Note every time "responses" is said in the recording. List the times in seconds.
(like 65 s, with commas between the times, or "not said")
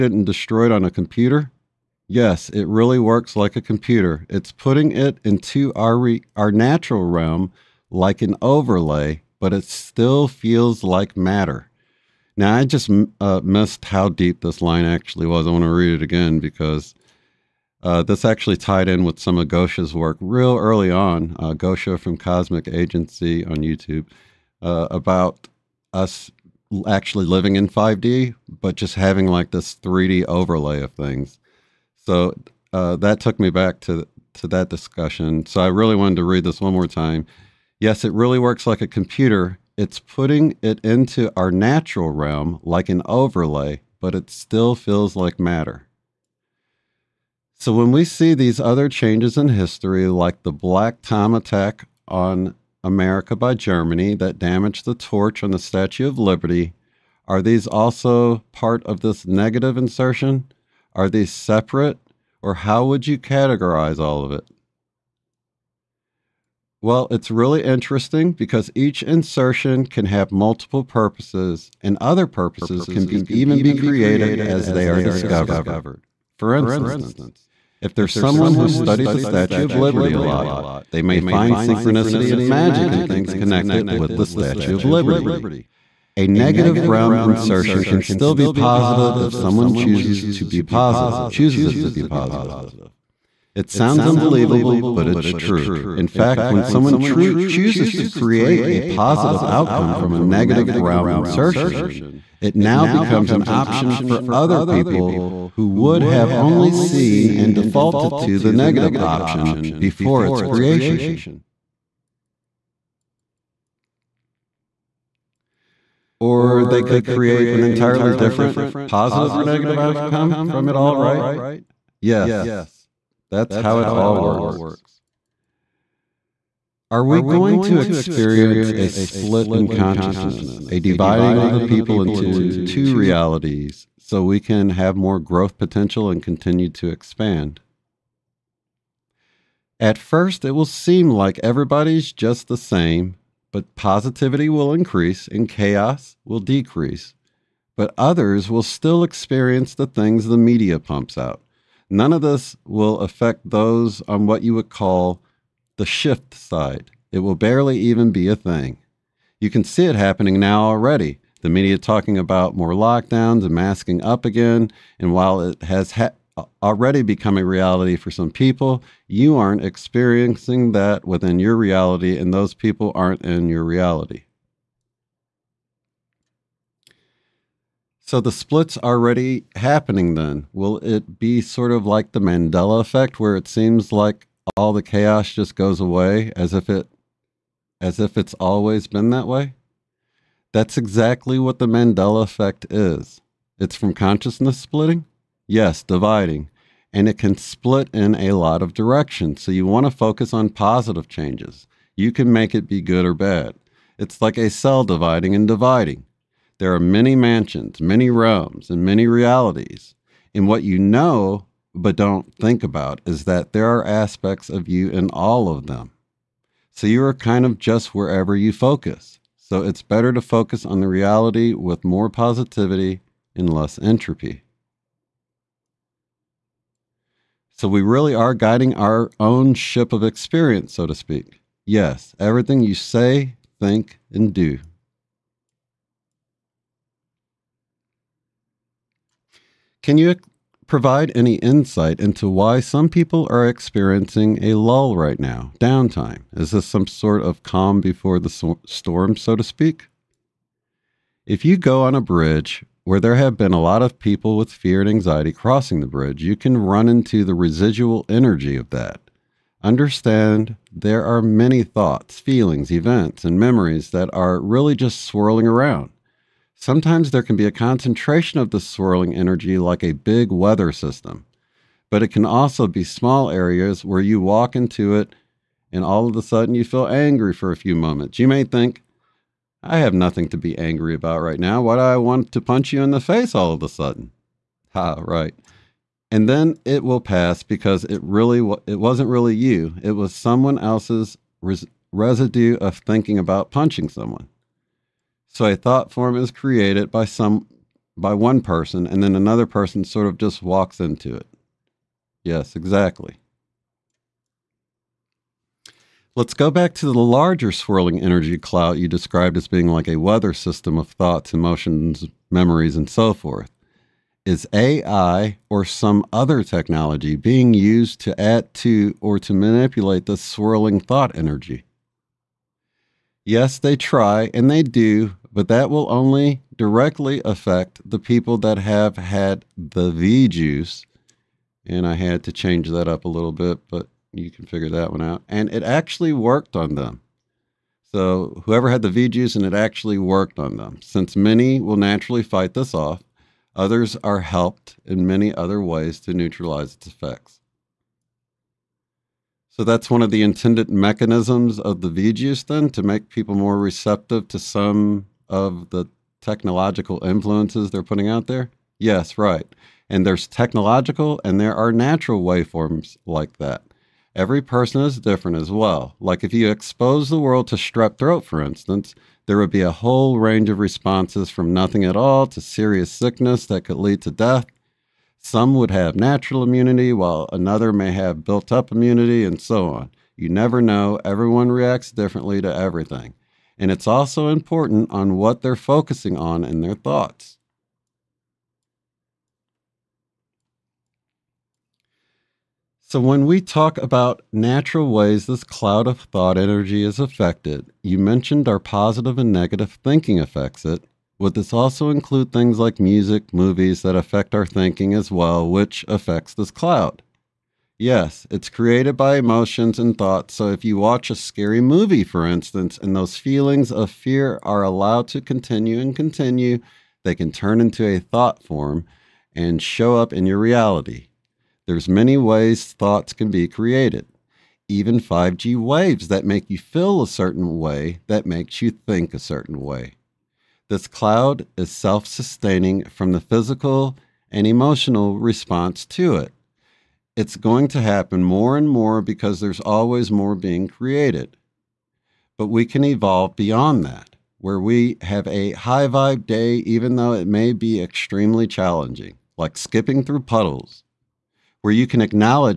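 370 s, 435 s.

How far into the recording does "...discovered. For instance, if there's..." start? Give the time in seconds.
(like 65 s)
74 s.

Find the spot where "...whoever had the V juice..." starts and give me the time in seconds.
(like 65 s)
338 s.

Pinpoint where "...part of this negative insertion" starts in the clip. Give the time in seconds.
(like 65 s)
58 s.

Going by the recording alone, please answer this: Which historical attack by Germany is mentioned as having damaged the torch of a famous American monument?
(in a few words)
Black Tom attack.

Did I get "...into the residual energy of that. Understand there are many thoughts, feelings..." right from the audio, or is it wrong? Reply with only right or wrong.
right.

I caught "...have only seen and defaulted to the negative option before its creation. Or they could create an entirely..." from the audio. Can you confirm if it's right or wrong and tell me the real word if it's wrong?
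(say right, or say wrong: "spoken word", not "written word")
right.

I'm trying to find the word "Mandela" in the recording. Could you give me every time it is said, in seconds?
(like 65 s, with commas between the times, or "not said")
182 s, 191 s.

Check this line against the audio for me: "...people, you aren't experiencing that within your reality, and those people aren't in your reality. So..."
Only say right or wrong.
right.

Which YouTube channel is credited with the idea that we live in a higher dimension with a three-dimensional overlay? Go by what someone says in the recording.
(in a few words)
Cosmic Agency.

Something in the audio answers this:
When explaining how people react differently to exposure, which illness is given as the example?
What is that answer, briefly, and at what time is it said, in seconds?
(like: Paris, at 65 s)
Strep throat, at 367 s.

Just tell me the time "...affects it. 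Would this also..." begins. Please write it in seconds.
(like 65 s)
400 s.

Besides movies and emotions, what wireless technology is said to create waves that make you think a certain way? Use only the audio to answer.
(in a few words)
5G.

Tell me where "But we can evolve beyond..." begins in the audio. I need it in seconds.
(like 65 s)
442 s.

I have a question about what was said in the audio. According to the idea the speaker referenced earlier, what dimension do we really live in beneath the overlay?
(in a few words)
5D.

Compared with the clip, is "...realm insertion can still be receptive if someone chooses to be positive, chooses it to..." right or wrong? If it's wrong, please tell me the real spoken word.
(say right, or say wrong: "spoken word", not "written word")
wrong: "positive", not "receptive".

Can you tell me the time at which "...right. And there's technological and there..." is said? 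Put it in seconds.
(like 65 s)
359 s.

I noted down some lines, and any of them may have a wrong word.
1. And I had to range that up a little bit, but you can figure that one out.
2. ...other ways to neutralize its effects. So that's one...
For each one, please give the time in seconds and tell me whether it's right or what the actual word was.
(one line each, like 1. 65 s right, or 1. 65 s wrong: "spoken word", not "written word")
1. 331 s wrong: "change", not "range"
2. 345 s right.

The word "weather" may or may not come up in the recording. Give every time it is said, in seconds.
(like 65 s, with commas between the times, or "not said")
270 s, 309 s.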